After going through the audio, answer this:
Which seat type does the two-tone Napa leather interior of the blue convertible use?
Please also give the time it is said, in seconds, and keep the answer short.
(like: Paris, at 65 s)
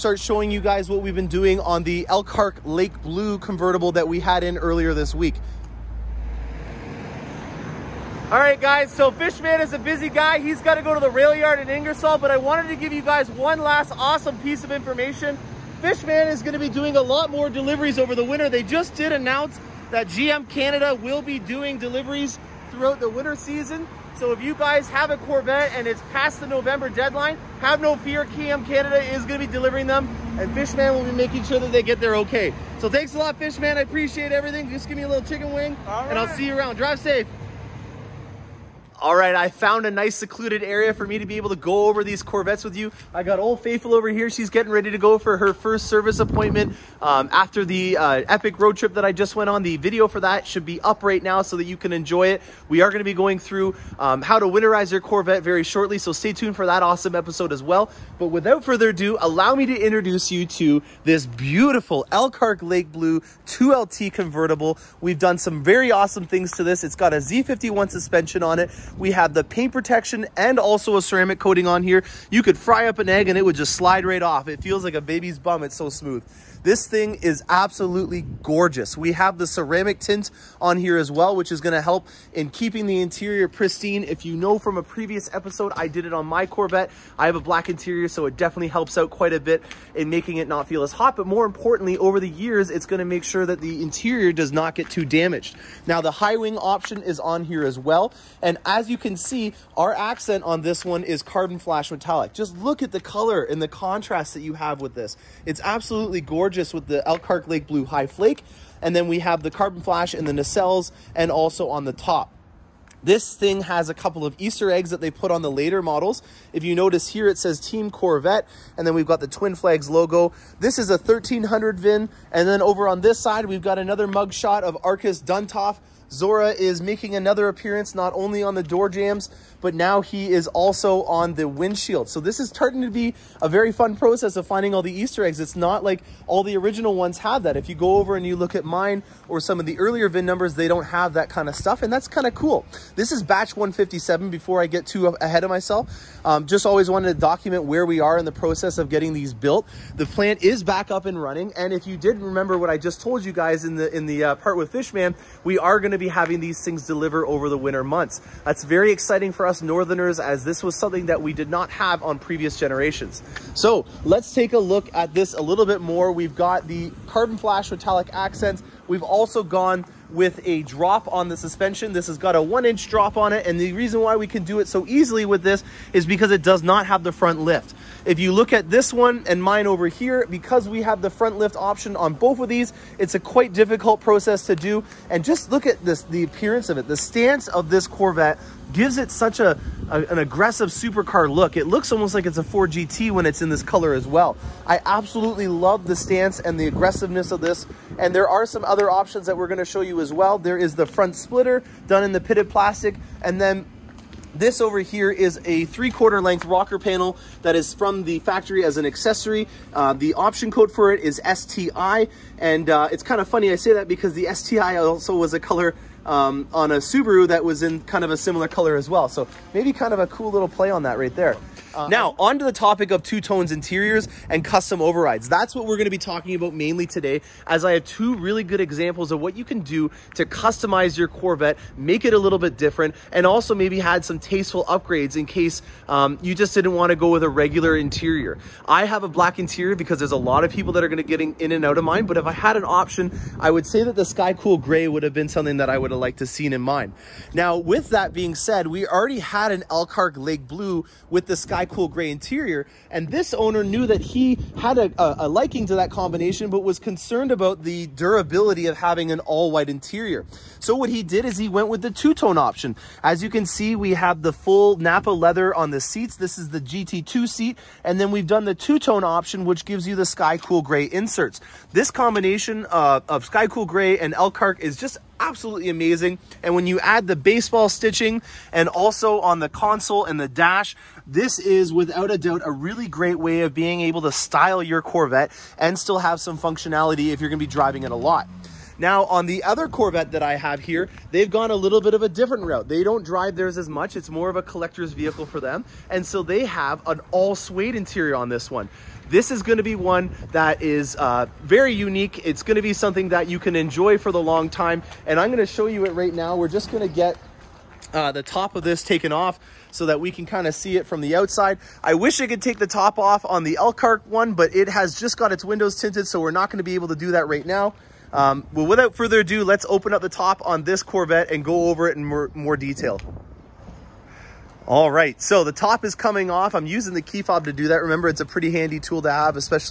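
GT2, at 266 s.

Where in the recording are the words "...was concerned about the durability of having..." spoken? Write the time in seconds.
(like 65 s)
256 s.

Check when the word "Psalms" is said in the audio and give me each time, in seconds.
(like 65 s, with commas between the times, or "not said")
not said.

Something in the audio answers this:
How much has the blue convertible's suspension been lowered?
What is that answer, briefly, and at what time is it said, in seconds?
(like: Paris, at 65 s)
1 inch, at 172 s.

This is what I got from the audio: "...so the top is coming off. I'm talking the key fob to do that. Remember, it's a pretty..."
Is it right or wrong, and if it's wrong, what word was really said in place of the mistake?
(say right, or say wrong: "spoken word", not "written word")
wrong: "using", not "talking".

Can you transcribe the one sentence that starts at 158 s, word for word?
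That's very exciting for us us Northerners as this was something that we did not have on previous generations.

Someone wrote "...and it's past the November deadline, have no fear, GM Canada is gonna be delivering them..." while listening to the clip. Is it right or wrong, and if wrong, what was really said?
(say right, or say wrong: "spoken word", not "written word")
right.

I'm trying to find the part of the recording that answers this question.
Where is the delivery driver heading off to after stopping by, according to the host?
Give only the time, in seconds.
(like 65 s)
11 s.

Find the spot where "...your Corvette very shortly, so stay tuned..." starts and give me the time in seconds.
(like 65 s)
54 s.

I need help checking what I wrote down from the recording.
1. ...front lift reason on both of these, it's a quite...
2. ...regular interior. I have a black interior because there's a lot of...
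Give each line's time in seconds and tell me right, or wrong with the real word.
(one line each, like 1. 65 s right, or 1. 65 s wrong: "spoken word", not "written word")
1. 181 s wrong: "option", not "reason"
2. 237 s right.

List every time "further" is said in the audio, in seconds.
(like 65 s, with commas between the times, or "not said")
58 s, 318 s.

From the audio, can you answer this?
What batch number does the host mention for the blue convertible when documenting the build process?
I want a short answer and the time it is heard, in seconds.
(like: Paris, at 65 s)
157, at 143 s.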